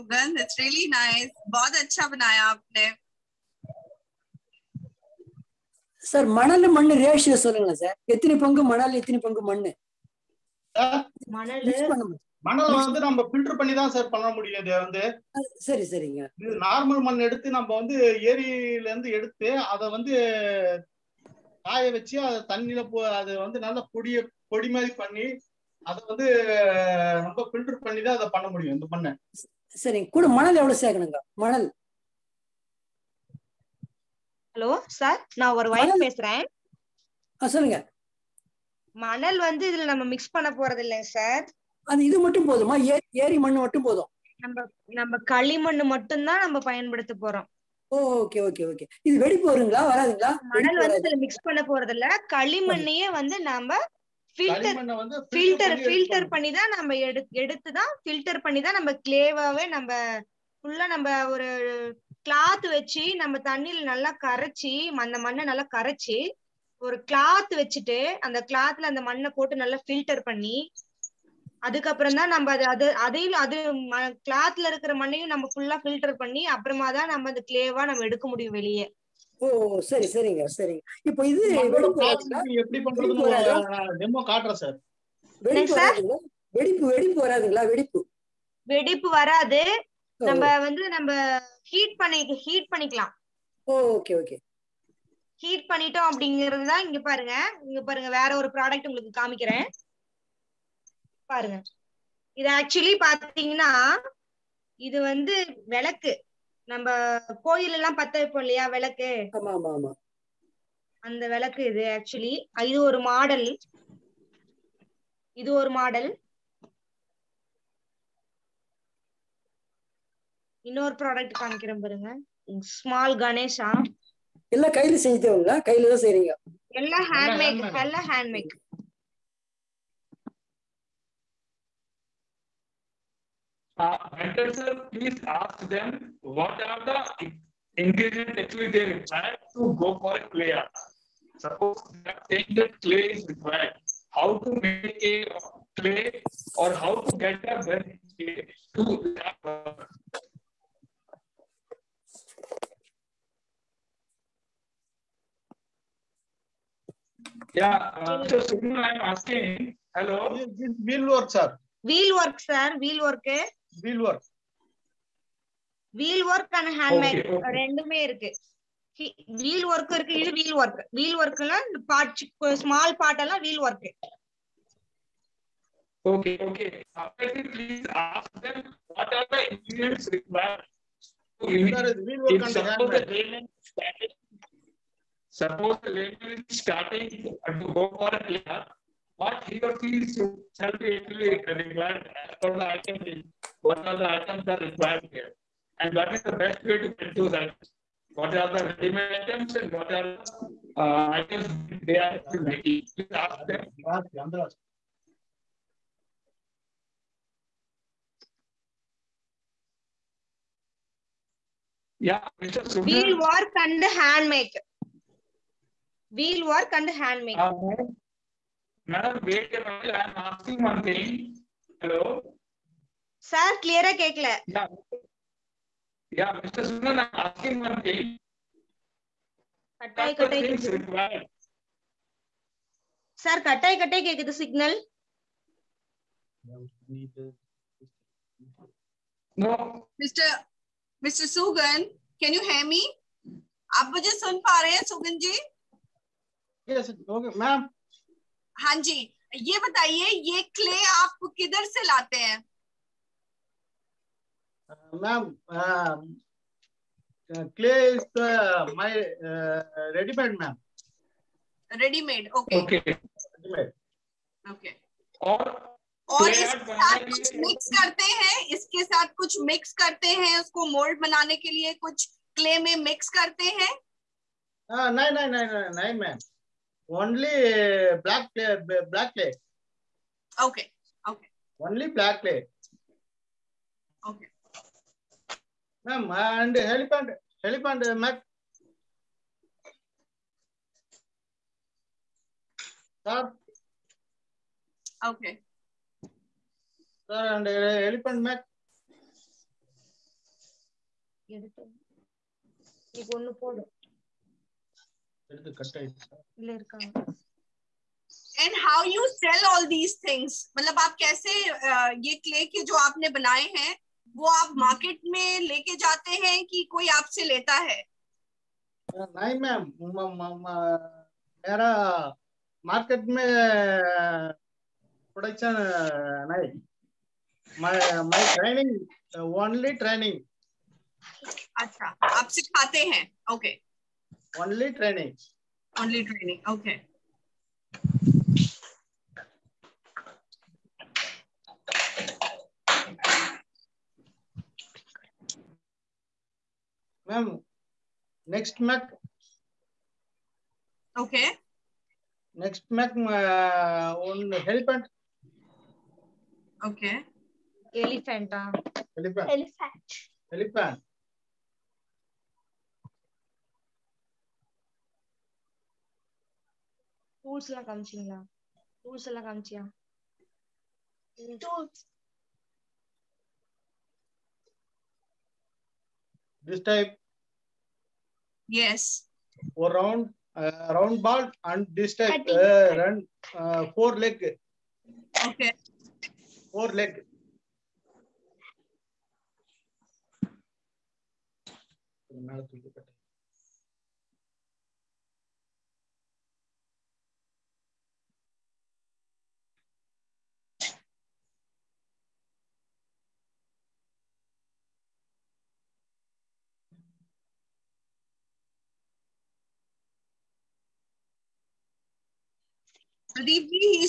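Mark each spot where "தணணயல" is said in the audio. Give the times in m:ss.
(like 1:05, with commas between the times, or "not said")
0:22, 1:03.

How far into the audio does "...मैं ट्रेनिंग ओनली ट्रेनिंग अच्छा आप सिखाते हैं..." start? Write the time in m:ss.
5:28.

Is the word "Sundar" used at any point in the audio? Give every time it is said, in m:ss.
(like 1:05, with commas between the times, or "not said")
3:32.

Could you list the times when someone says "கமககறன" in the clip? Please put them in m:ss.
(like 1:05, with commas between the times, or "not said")
1:39, 2:01.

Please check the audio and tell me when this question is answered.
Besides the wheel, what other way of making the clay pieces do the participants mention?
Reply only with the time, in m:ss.
2:46.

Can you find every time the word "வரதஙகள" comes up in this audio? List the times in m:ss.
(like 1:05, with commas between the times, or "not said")
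0:49, 1:27.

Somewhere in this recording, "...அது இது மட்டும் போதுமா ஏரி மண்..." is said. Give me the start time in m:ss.
0:41.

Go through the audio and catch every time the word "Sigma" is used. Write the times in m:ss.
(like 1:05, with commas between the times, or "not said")
2:38.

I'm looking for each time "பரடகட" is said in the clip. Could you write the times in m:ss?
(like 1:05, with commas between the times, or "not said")
1:38, 2:01.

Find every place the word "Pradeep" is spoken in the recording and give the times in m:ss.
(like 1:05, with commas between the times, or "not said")
6:53.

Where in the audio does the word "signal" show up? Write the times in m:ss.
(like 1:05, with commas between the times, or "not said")
3:54.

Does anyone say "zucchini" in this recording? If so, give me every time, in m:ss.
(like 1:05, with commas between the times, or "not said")
not said.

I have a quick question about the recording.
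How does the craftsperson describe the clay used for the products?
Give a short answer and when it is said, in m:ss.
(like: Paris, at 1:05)
Readymade, at 4:17.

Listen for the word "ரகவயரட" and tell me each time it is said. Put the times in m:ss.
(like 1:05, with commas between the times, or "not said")
3:00.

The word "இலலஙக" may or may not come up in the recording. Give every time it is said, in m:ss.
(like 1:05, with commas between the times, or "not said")
0:40.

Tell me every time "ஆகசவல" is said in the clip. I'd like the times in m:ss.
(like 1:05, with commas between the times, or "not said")
1:42, 1:51.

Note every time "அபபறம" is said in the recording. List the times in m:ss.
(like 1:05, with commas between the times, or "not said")
1:16.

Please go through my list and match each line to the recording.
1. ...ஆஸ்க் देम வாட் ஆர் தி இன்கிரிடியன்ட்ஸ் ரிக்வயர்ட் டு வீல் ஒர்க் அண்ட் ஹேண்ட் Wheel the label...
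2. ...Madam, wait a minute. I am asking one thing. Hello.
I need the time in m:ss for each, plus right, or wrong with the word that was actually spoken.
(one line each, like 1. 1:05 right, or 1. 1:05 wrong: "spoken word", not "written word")
1. 2:58 wrong: "Suppose", not "Wheel"
2. 3:38 right.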